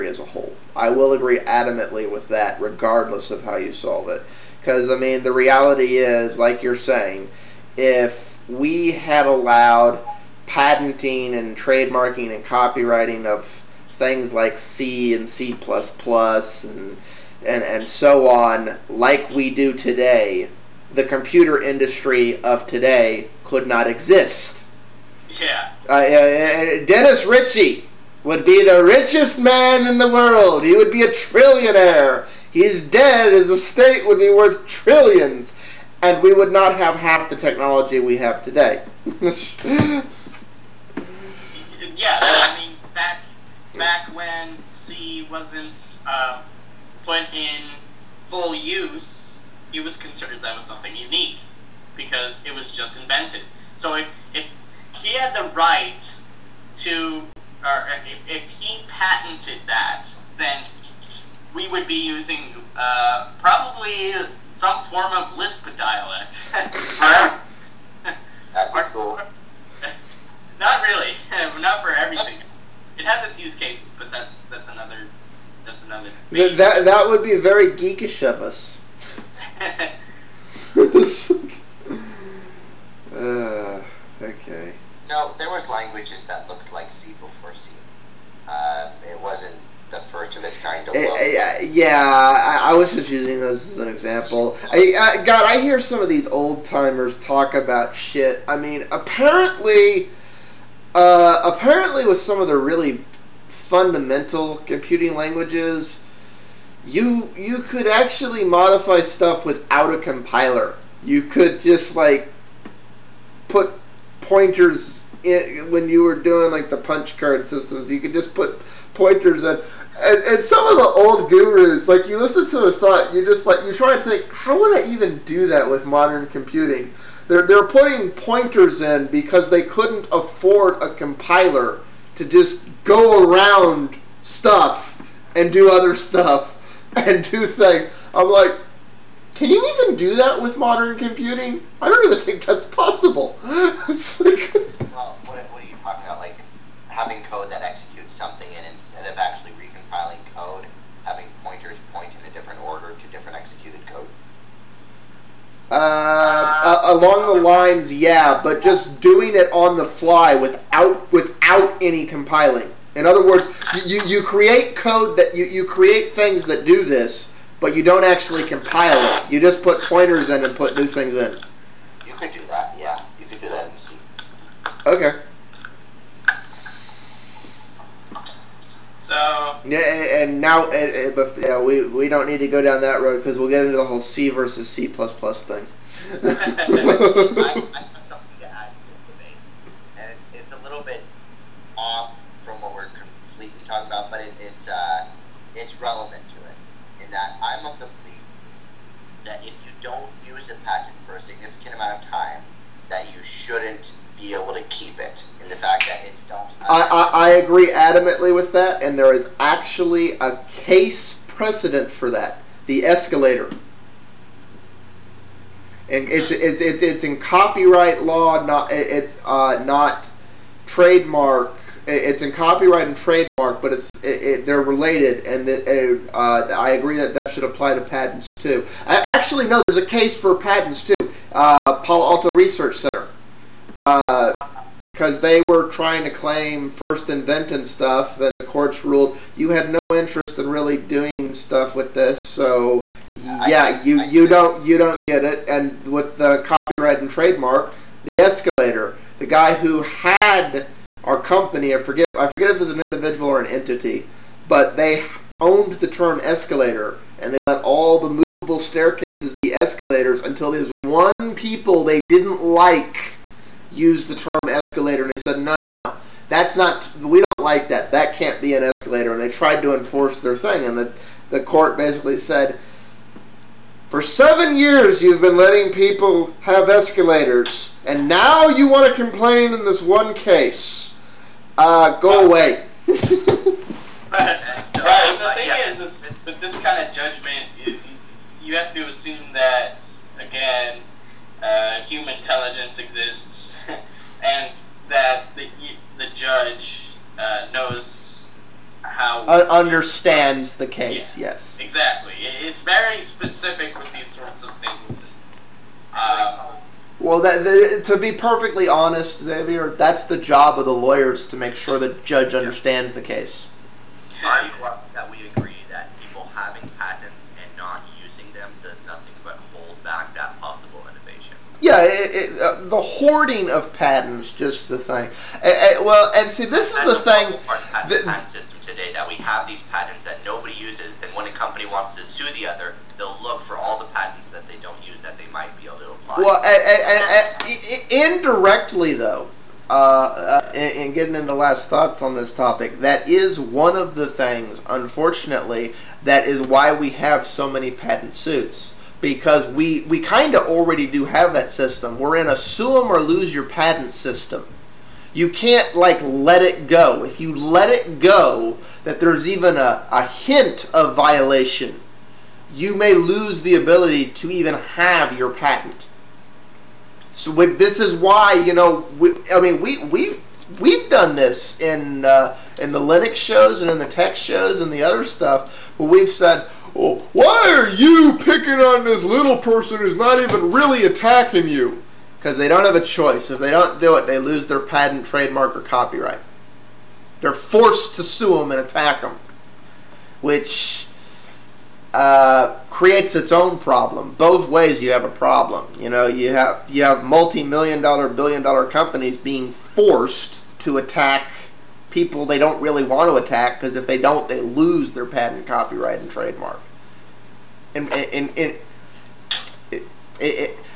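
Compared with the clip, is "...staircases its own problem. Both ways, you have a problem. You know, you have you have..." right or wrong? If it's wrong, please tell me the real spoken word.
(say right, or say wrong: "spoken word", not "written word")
wrong: "creates", not "staircases".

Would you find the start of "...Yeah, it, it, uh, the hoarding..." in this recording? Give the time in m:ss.
5:21.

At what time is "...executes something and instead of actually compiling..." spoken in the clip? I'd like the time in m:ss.
2:27.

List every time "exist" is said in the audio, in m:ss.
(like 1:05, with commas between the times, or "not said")
0:23, 4:52.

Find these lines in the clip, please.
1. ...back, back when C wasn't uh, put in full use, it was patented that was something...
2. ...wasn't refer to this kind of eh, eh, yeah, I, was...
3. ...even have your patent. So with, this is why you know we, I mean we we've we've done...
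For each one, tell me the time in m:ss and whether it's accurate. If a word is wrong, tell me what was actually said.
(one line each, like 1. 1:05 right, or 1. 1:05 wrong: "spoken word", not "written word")
1. 0:42 wrong: "considered", not "patented"
2. 1:29 right
3. 6:04 right.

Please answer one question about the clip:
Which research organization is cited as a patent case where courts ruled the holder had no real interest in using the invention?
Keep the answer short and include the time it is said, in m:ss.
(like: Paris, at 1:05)
Palo Alto Research Center, at 3:51.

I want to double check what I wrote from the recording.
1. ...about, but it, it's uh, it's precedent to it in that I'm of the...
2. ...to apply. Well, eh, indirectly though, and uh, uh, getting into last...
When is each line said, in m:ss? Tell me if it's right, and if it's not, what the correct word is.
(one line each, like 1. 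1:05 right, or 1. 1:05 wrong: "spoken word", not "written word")
1. 3:13 wrong: "relevant", not "precedent"
2. 5:35 right.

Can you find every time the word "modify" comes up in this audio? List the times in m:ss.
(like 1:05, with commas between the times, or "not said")
1:48.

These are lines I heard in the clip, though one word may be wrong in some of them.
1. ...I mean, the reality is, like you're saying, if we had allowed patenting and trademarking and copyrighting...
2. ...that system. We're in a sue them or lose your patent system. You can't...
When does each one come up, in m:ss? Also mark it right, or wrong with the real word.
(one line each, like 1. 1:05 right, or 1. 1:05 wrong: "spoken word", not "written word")
1. 0:04 right
2. 5:51 right.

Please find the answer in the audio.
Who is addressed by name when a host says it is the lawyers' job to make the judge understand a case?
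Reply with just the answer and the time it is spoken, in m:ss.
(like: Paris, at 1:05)
Xavier, at 5:09.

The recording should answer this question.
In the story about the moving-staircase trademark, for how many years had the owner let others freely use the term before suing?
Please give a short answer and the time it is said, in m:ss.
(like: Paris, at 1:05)
7, at 4:34.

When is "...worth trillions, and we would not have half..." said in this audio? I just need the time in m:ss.
0:34.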